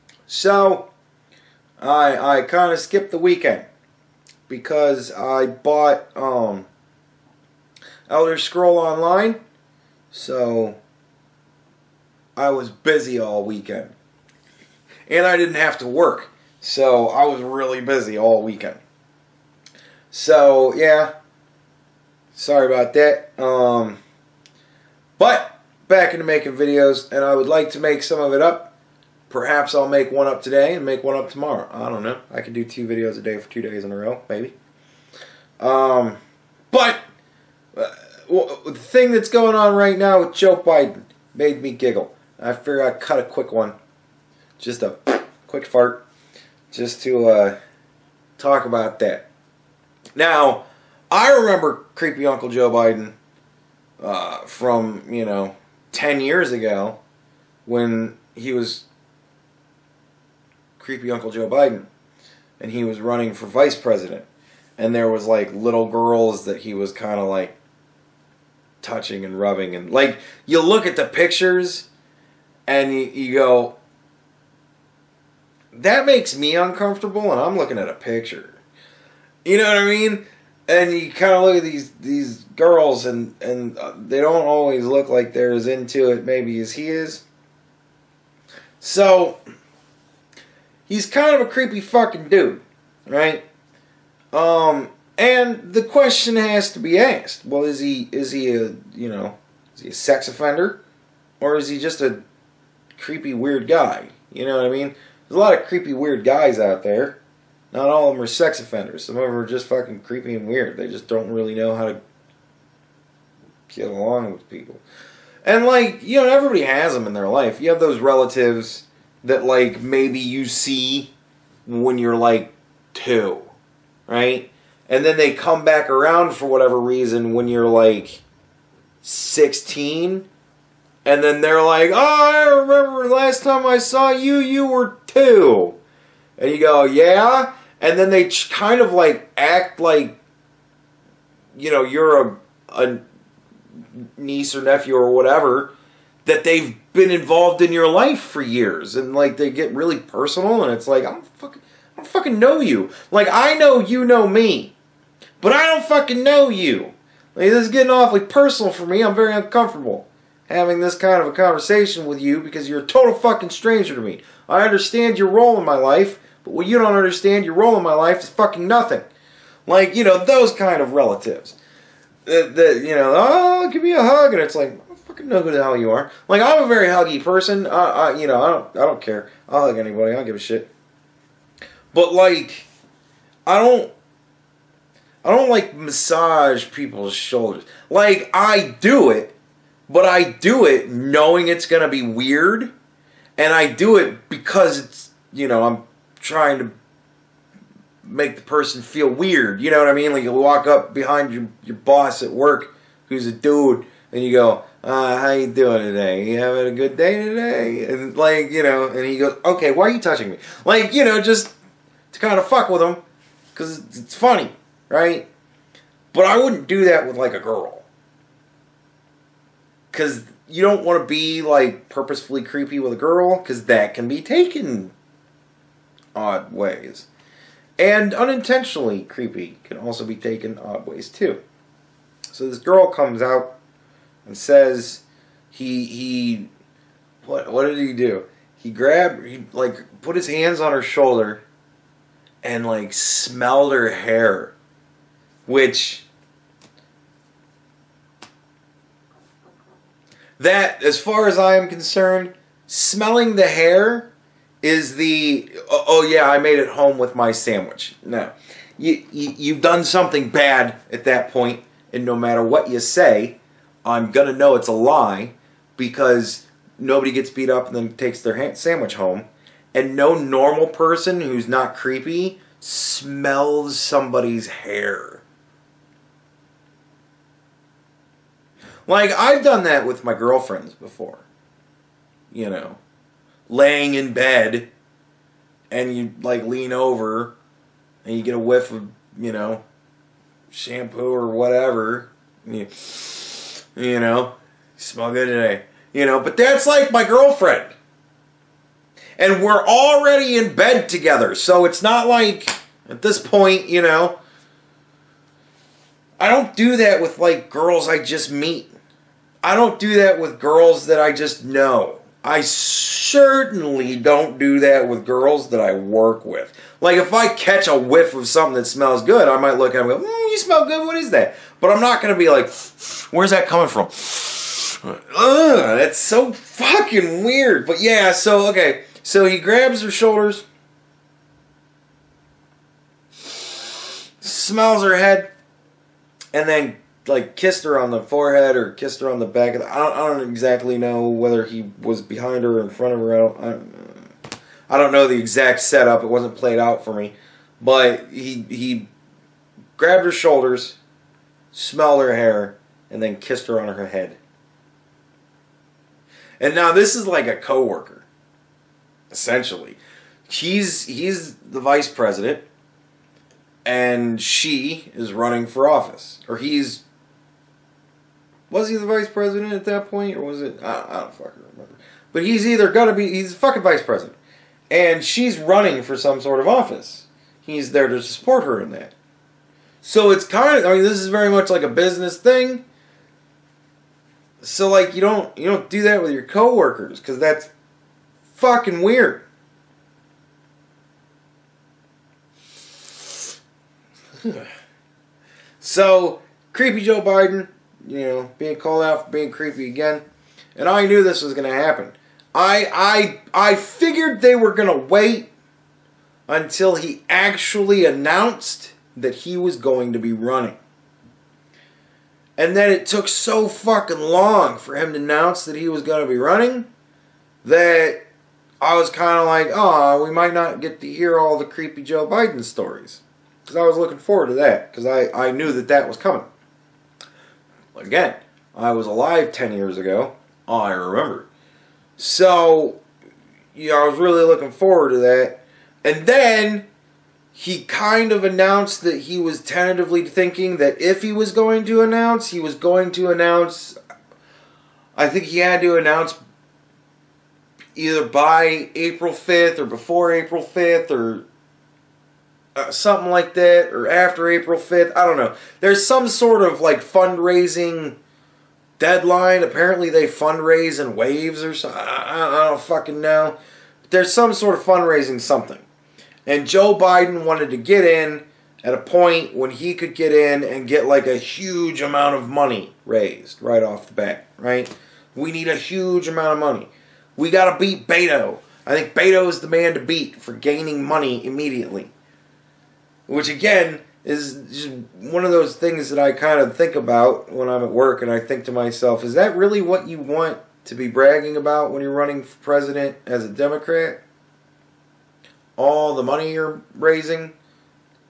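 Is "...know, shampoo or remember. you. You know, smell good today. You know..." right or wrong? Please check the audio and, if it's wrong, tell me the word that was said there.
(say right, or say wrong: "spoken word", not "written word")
wrong: "whatever", not "remember".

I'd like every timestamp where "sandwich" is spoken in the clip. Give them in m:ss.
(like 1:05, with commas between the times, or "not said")
4:17, 4:28.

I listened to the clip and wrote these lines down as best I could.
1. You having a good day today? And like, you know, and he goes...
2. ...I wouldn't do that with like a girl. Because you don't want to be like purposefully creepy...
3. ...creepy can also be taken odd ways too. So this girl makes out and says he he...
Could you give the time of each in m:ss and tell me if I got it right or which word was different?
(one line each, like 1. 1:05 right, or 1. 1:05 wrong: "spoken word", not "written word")
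1. 3:26 right
2. 3:36 right
3. 3:49 wrong: "comes", not "makes".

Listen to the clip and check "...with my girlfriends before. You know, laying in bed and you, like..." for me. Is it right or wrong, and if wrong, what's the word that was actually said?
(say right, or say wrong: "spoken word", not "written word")
right.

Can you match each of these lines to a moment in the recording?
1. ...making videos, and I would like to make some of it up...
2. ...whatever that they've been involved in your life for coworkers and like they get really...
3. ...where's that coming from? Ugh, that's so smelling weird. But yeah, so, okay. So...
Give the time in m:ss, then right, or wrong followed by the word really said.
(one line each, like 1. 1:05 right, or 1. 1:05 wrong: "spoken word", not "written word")
1. 0:26 right
2. 2:25 wrong: "years", not "coworkers"
3. 5:23 wrong: "fucking", not "smelling".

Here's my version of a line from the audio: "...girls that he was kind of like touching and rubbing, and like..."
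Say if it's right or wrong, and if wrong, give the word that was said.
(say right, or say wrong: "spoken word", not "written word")
right.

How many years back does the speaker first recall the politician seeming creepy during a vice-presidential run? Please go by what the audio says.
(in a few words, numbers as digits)
10 years.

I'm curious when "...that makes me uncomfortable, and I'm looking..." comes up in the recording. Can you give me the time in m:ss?
1:15.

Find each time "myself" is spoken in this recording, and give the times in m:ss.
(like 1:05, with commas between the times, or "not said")
8:08.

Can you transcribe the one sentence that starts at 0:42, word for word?
I figure I cut a quick one, just a quick fart, just to uh, talk about that.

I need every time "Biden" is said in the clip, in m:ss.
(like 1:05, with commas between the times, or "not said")
0:40, 0:52, 1:01, 6:37, 7:02, 7:46.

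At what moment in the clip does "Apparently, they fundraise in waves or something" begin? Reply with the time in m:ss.
7:39.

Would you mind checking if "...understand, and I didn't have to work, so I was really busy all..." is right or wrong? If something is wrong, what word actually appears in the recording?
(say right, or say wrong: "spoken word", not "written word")
wrong: "weekend", not "understand".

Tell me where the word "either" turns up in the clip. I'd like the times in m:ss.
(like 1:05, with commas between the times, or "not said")
6:12, 7:27.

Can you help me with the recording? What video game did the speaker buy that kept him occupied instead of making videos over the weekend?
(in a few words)
Elder Scroll Online.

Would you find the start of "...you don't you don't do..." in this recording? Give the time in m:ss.
6:24.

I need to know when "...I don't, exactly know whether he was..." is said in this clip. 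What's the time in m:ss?
5:39.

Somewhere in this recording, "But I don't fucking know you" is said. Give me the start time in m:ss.
2:35.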